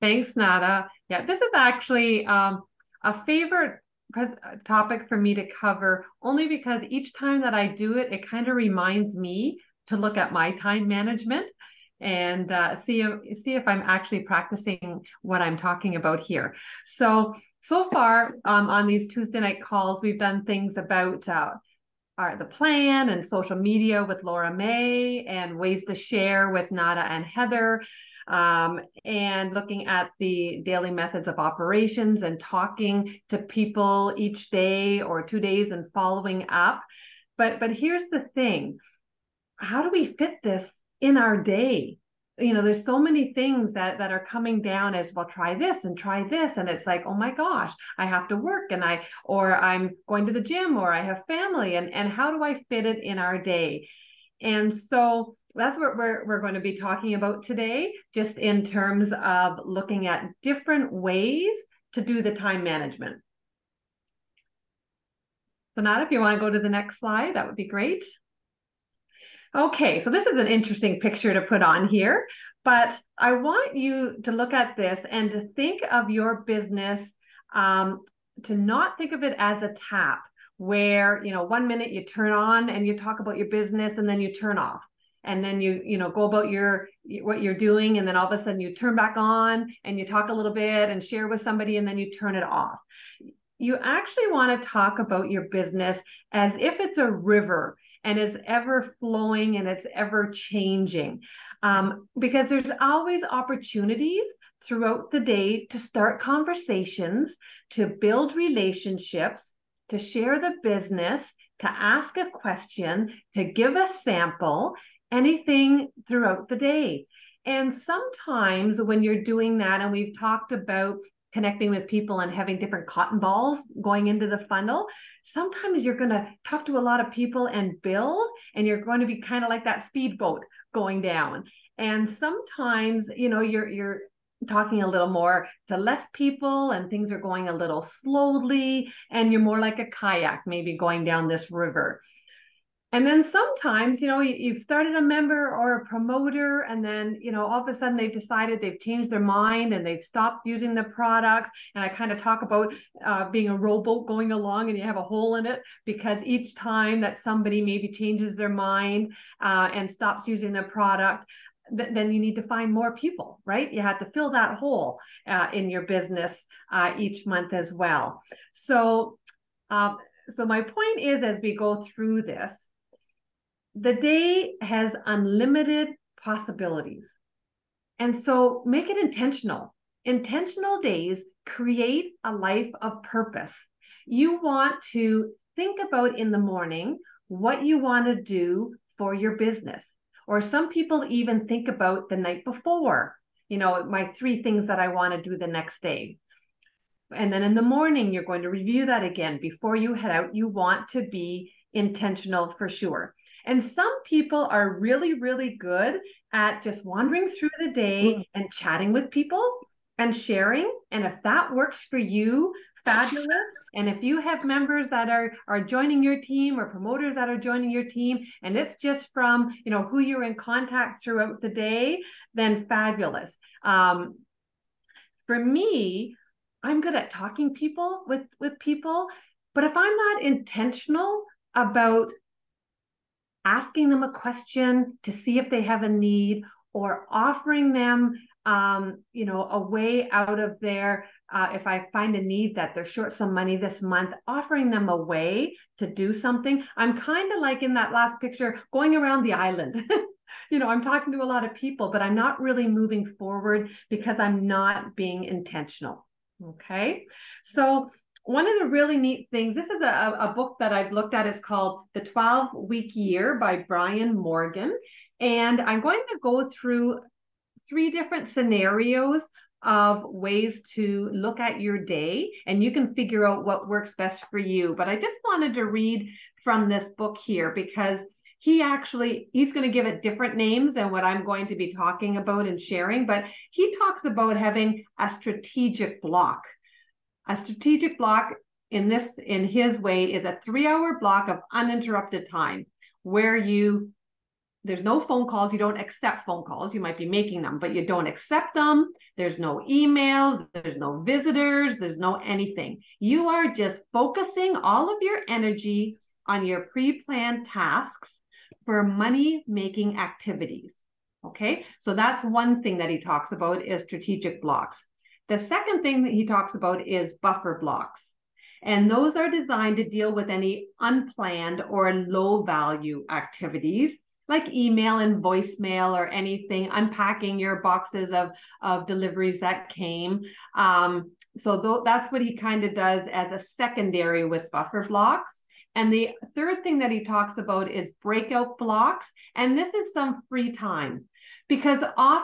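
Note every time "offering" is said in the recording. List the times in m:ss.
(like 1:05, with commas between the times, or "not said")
3:57, 4:04.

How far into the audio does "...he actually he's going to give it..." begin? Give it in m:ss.
4:38.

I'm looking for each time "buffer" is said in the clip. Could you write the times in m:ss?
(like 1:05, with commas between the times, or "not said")
5:17, 5:34.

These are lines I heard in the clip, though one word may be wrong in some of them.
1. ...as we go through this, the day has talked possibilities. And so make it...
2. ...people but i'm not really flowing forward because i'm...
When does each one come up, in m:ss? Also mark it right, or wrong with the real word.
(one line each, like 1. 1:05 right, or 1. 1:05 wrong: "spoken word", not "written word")
1. 2:51 wrong: "unlimited", not "talked"
2. 4:11 wrong: "moving", not "flowing".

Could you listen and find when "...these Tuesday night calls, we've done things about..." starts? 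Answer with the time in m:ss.
0:18.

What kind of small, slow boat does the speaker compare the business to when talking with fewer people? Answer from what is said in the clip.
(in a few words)
kayak.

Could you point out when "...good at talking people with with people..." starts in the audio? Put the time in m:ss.
3:46.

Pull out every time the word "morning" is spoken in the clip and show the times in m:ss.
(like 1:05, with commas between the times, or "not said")
3:06, 3:17.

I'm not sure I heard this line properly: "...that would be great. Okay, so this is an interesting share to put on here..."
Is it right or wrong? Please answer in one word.
wrong.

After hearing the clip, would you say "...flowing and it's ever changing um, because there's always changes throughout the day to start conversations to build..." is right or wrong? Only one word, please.
wrong.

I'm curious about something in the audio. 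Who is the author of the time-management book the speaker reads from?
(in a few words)
Brian Moran.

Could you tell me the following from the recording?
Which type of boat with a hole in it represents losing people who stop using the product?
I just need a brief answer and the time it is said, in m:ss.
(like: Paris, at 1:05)
rowboat, at 2:33.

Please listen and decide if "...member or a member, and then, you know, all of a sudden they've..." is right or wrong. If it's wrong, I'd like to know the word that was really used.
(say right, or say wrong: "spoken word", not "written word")
wrong: "promoter", not "member".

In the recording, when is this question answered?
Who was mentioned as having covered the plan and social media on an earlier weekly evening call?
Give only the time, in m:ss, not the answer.
0:24.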